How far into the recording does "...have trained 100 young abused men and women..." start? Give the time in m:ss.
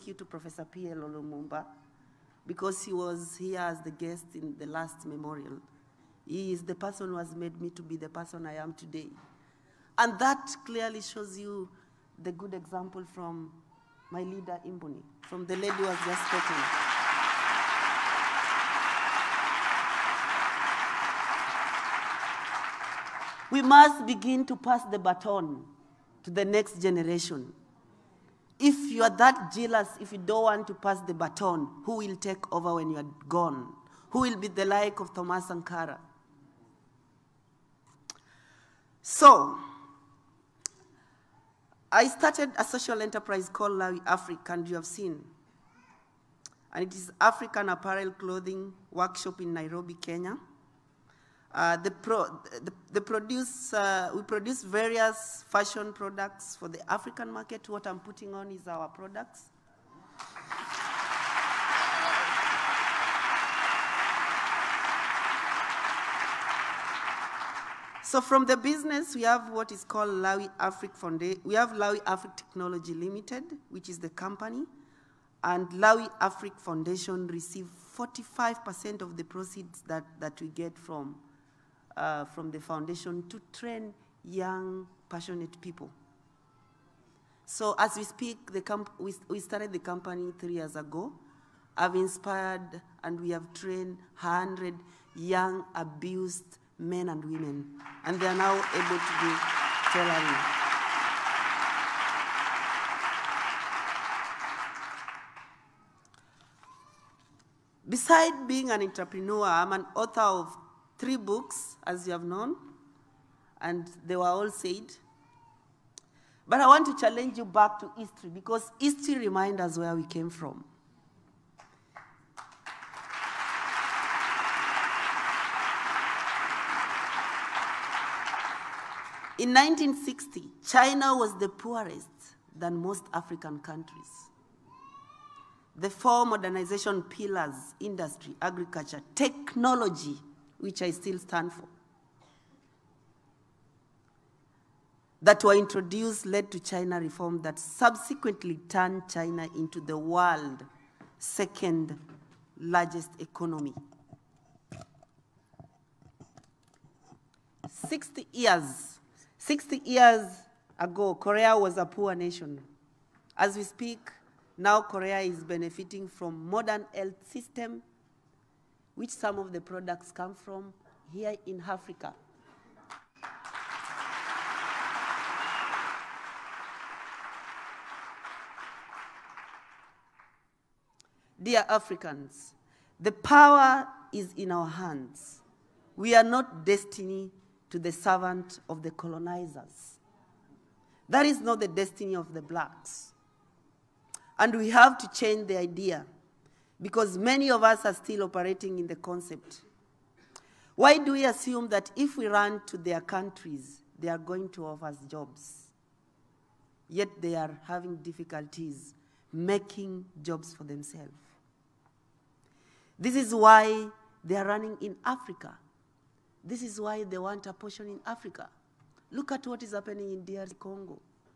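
1:33.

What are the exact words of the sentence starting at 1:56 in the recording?
But I want to challenge you back to history because history reminds us where we came from.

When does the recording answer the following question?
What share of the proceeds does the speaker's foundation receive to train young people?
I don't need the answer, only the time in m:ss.
1:17.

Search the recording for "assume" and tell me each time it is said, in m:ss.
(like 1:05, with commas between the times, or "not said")
3:21.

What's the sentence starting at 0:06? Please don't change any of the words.
He is the person who has made me to be the person I am today.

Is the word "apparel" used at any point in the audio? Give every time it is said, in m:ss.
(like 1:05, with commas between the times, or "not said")
0:47.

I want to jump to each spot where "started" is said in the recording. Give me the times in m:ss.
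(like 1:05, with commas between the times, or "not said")
0:42, 1:29.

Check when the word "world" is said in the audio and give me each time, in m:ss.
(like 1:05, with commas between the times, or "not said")
2:29.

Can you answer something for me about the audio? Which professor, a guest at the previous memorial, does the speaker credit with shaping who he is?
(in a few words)
PLO Olumumba.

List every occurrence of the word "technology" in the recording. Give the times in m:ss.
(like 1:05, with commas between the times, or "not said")
1:12, 2:19.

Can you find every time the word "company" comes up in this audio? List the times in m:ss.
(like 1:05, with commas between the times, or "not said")
1:14, 1:29.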